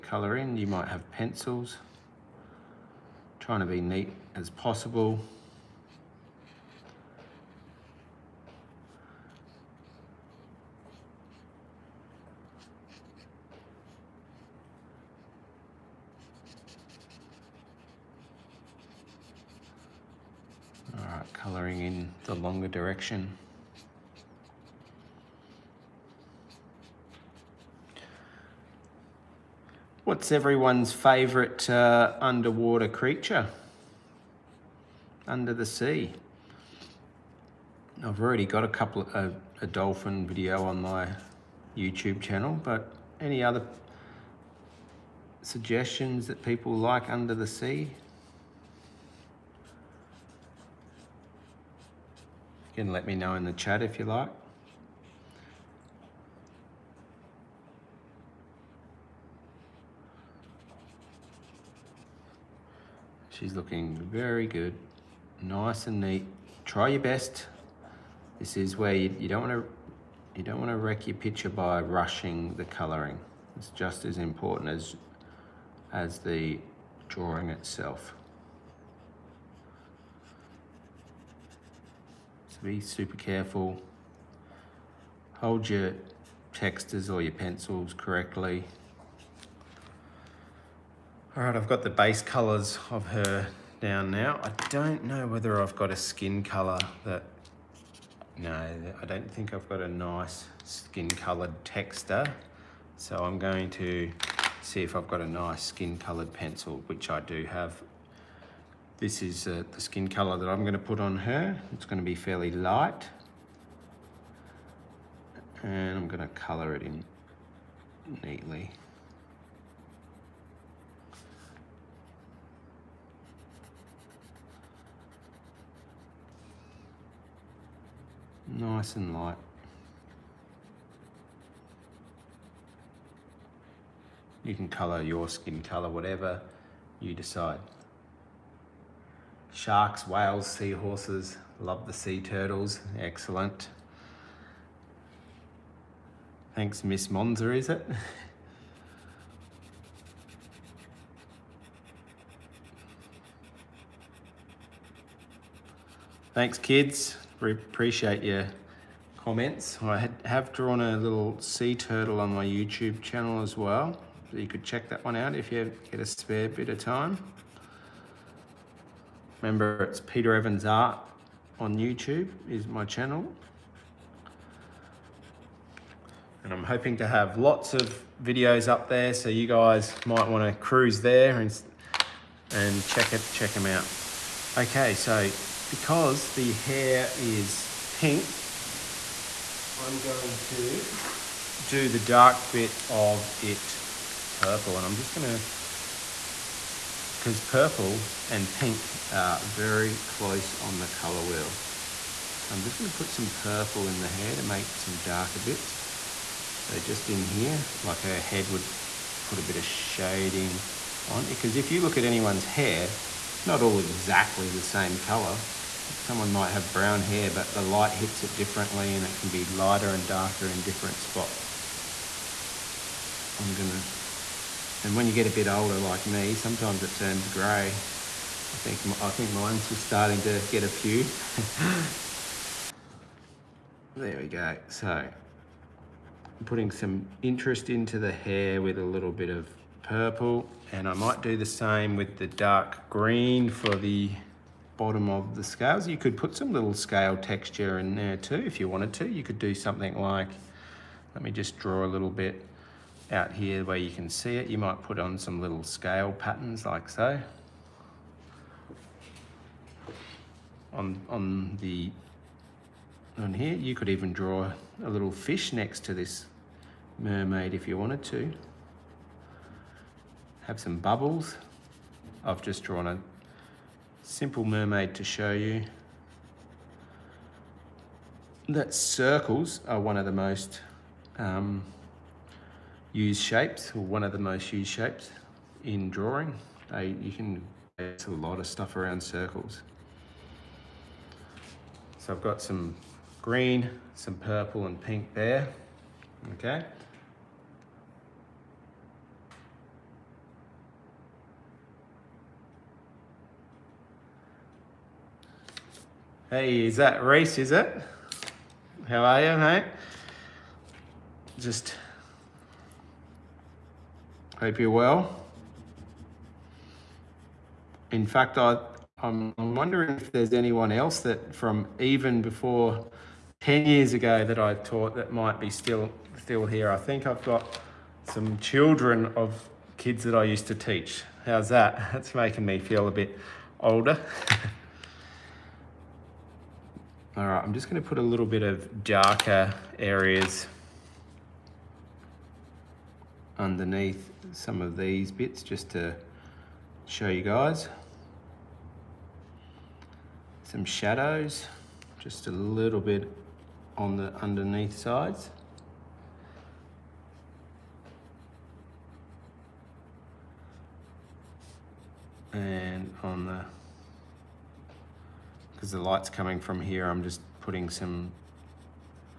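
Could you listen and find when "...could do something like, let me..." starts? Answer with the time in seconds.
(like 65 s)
249 s.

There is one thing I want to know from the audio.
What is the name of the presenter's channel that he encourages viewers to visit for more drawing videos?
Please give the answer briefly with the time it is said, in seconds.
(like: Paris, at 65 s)
Peter Evans Art, at 169 s.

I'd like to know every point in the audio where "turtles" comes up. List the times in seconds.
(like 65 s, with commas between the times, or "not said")
142 s, 161 s.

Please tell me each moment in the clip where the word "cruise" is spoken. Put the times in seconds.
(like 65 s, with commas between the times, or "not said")
180 s.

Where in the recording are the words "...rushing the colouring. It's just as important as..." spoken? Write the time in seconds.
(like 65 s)
71 s.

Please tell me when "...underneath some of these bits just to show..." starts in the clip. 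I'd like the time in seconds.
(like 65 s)
343 s.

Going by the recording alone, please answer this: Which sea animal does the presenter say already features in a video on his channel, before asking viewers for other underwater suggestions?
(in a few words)
Dolphin.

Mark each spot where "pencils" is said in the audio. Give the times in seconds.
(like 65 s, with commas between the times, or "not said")
1 s, 87 s, 106 s.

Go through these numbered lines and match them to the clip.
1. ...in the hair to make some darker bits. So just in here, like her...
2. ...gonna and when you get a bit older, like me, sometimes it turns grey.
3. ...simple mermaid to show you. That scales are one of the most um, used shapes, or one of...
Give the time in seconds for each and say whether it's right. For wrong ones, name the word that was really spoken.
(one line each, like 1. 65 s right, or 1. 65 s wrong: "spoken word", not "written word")
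1. 203 s right
2. 223 s right
3. 274 s wrong: "circles", not "scales".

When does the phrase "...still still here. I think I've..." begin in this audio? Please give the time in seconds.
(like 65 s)
325 s.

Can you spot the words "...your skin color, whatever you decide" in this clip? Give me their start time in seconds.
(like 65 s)
135 s.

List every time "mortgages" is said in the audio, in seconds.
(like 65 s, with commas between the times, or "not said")
not said.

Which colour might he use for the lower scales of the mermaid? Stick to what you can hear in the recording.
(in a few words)
Dark green.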